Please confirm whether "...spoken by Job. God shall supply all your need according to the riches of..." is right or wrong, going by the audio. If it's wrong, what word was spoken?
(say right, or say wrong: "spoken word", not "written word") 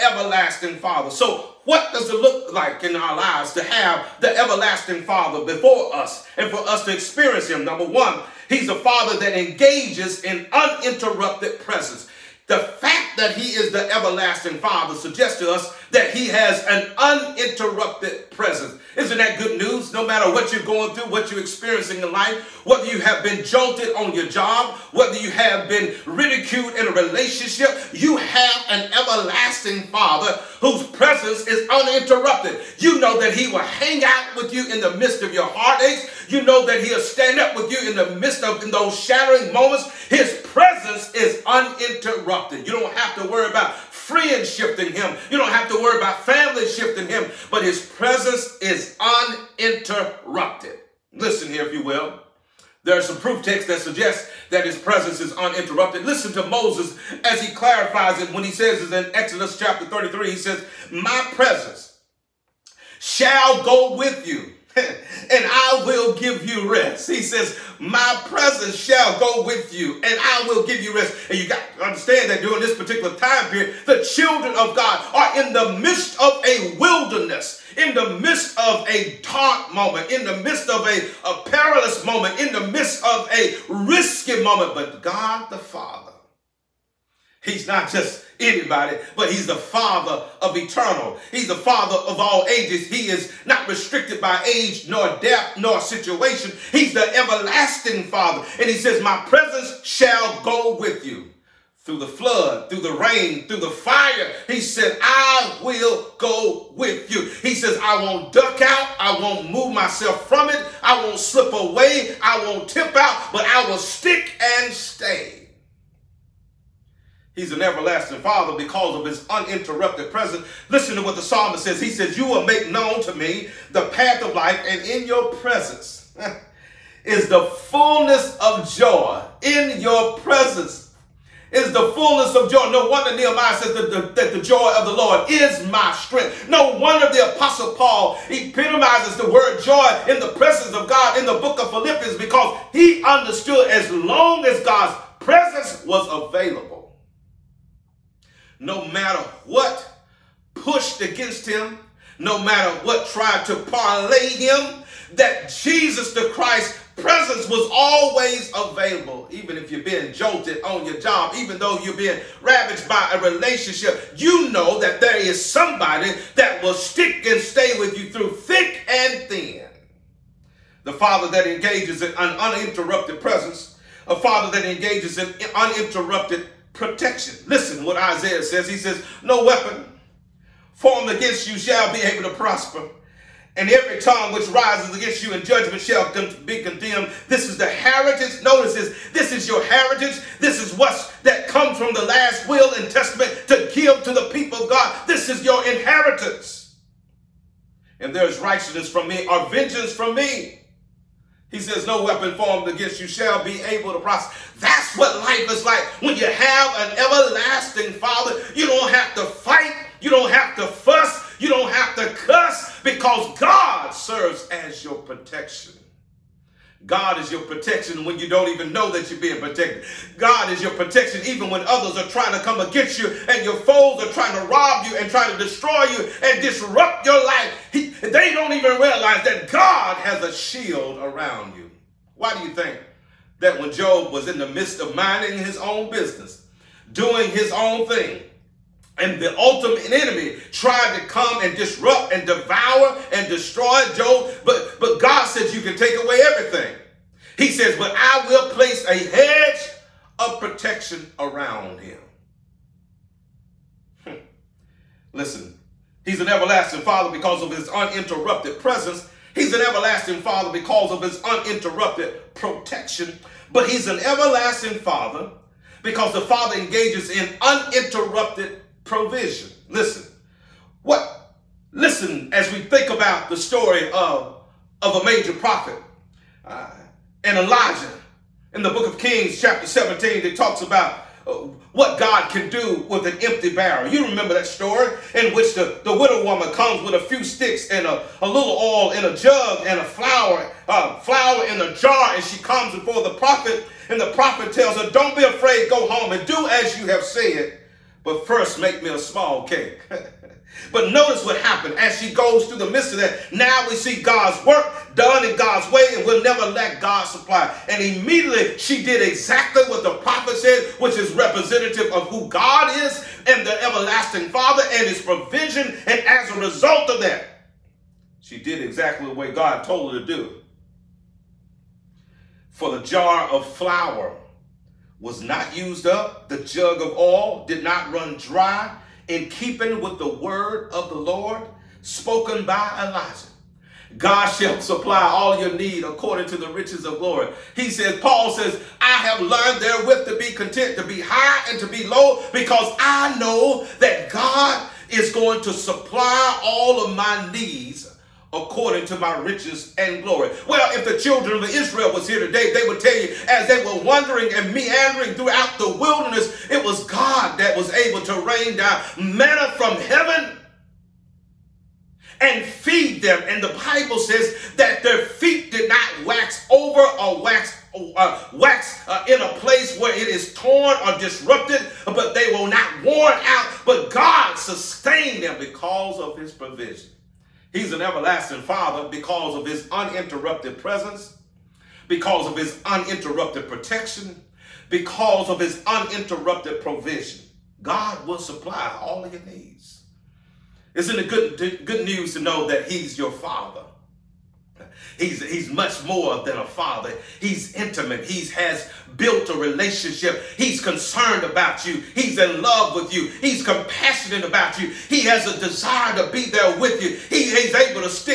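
wrong: "Elijah", not "Job".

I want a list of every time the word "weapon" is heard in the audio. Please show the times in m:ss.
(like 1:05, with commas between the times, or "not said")
2:59, 3:22.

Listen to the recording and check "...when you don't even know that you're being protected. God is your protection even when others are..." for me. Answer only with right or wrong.
right.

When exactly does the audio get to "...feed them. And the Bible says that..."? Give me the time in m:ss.
6:02.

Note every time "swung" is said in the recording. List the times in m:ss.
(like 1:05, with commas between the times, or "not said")
not said.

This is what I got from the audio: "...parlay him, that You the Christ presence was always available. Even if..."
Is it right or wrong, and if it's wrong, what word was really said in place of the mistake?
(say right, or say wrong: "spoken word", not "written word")
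wrong: "Jesus", not "You".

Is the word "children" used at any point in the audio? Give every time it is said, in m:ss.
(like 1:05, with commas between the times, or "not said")
1:14, 5:50.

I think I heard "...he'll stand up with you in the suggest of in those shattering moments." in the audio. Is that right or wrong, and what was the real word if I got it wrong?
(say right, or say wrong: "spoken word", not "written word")
wrong: "midst", not "suggest".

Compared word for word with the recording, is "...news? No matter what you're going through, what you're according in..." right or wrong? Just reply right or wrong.
wrong.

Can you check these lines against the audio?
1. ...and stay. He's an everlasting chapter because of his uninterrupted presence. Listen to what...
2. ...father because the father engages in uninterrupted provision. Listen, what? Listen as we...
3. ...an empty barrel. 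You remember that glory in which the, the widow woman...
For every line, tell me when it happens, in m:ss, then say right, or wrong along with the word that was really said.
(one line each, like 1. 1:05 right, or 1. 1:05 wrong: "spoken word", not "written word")
1. 1:54 wrong: "father", not "chapter"
2. 4:24 right
3. 4:43 wrong: "story", not "glory".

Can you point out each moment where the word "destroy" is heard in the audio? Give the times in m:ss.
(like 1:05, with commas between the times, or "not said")
3:45, 4:03.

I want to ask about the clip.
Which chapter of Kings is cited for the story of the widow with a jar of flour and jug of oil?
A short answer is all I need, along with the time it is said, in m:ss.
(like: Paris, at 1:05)
Chapter 17, at 4:39.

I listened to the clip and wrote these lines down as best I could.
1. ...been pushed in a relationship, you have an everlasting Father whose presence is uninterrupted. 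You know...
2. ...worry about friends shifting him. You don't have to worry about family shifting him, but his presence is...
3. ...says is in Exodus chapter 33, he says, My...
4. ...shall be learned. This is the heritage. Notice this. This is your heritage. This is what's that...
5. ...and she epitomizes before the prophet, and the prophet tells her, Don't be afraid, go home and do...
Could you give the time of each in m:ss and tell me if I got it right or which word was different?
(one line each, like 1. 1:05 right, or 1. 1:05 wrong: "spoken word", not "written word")
1. 0:25 wrong: "ridiculed", not "pushed"
2. 0:43 right
3. 0:58 right
4. 3:05 wrong: "condemned", not "learned"
5. 4:52 wrong: "comes", not "epitomizes".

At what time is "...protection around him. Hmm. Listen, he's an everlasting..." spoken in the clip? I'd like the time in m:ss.
4:10.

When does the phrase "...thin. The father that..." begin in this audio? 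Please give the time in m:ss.
2:49.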